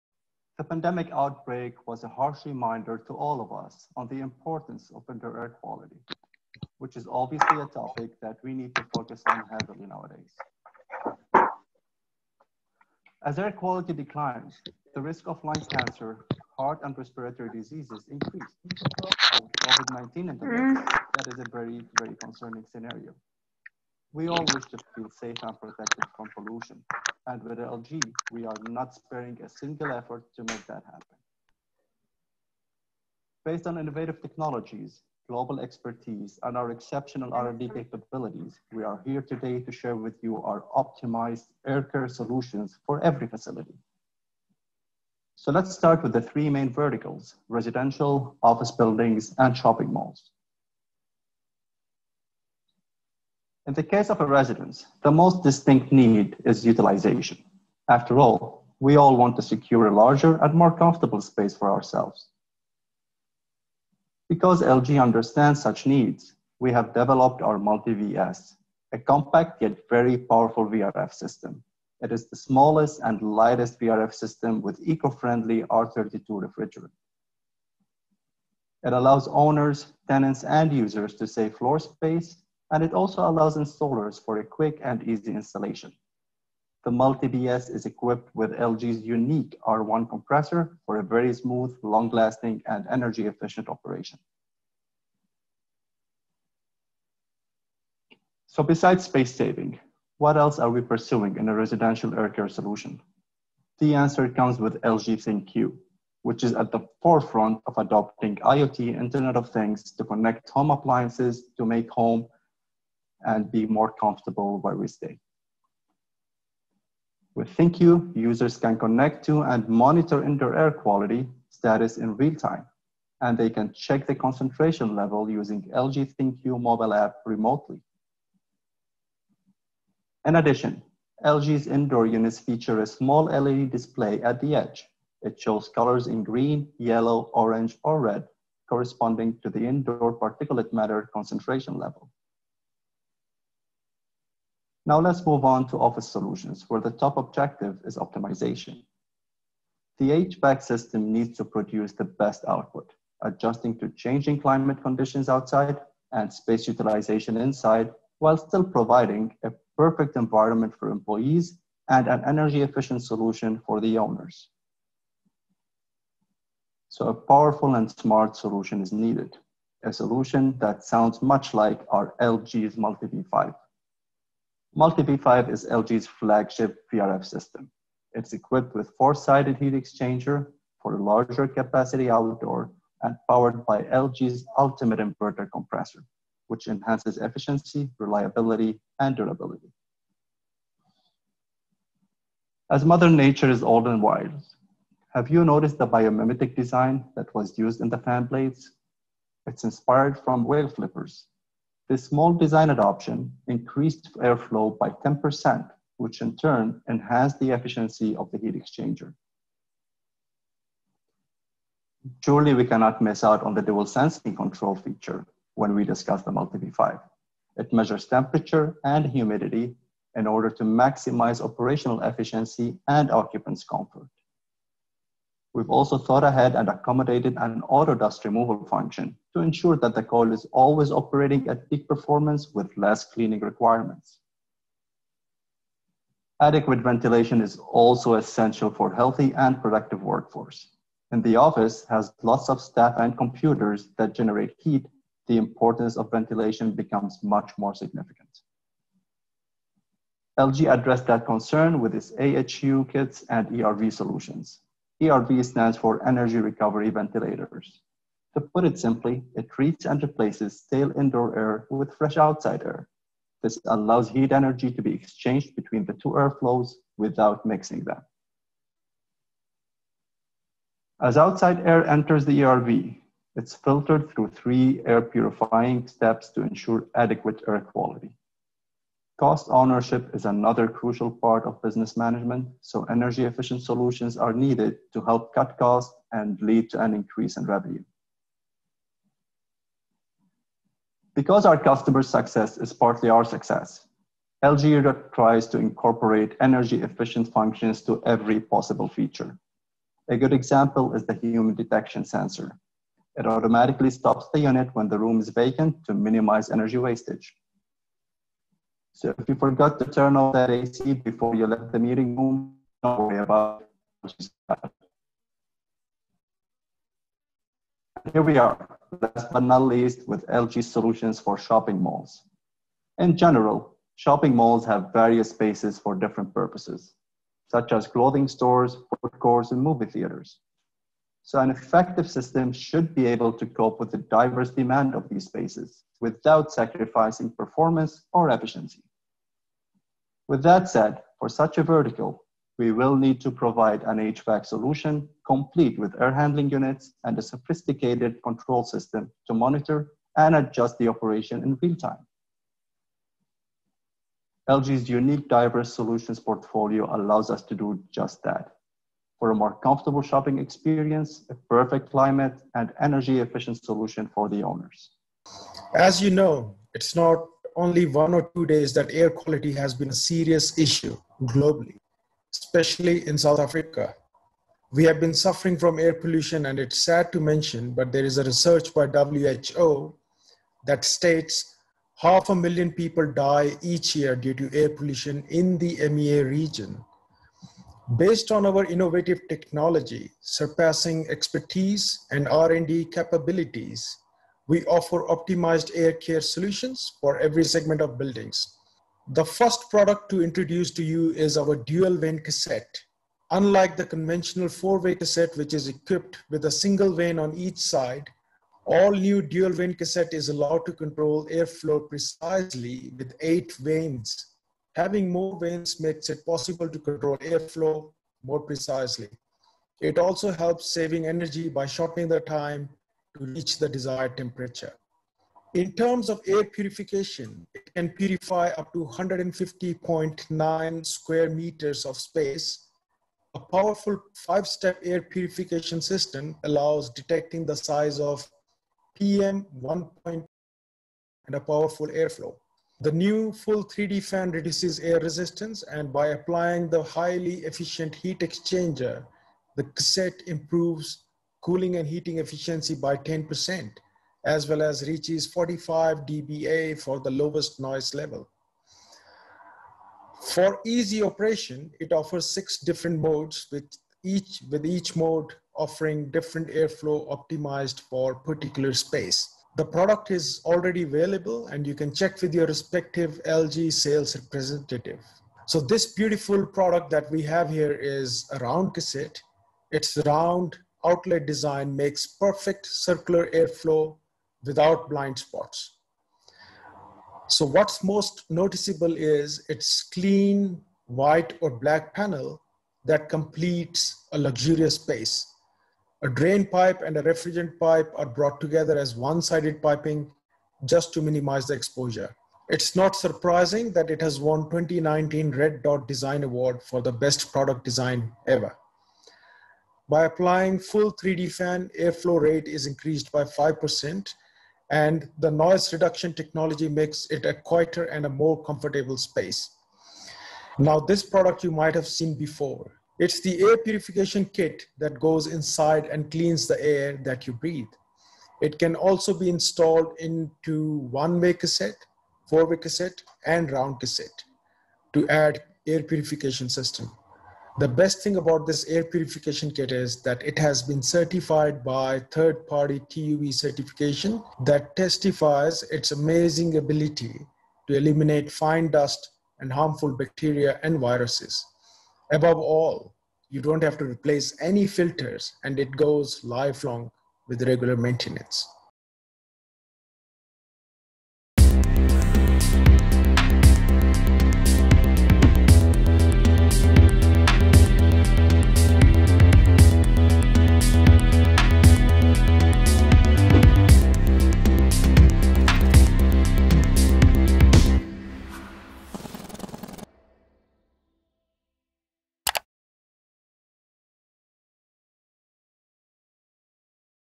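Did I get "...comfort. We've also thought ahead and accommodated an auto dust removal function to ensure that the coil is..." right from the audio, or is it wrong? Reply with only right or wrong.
right.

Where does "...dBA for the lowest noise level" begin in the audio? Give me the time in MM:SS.
07:36.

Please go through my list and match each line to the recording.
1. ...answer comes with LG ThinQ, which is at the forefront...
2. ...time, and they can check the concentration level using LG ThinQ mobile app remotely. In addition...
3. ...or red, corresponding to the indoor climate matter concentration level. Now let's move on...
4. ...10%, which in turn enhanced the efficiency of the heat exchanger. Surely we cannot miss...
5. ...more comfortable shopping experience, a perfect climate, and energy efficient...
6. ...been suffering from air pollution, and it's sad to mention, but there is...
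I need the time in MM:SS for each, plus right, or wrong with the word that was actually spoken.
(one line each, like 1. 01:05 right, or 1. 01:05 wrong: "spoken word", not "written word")
1. 01:43 right
2. 02:02 right
3. 02:17 wrong: "particulate", not "climate"
4. 03:25 right
5. 05:59 right
6. 06:14 right.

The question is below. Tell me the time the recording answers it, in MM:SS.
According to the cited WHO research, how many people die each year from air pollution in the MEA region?
06:21.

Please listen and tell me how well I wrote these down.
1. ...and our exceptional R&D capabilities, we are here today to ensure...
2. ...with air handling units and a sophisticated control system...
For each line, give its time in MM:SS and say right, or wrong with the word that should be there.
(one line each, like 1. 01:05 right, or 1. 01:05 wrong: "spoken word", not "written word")
1. 00:36 wrong: "share", not "ensure"
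2. 05:45 right.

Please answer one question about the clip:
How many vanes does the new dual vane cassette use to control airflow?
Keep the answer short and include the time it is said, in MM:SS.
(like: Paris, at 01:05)
8, at 06:53.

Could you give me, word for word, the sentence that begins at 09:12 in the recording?
Above all, you don't have to replace any filters and it goes lifelong with regular maintenance.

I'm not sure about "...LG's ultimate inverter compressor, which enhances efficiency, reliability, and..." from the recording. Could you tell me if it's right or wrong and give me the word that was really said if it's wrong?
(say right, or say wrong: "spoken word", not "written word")
right.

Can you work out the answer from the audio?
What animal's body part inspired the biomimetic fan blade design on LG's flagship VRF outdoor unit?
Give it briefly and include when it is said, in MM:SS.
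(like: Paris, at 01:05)
Whale flippers, at 03:20.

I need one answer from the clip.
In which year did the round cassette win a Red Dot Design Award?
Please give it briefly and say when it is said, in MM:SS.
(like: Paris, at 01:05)
2019, at 08:24.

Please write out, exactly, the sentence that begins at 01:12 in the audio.
It is the smallest and lightest VRF system with eco-friendly R32 refrigerant.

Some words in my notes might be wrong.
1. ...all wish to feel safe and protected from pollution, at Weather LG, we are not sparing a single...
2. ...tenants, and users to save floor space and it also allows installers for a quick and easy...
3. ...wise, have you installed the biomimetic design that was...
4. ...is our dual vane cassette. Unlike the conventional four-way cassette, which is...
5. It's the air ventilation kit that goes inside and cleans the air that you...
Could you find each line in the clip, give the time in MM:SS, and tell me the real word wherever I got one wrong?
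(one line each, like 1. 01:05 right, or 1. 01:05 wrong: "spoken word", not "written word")
1. 00:24 right
2. 01:20 right
3. 03:14 wrong: "noticed", not "installed"
4. 06:41 right
5. 08:42 wrong: "purification", not "ventilation".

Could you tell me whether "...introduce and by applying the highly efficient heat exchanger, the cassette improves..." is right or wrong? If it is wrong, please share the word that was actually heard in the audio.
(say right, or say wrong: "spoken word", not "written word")
wrong: "resistance", not "introduce".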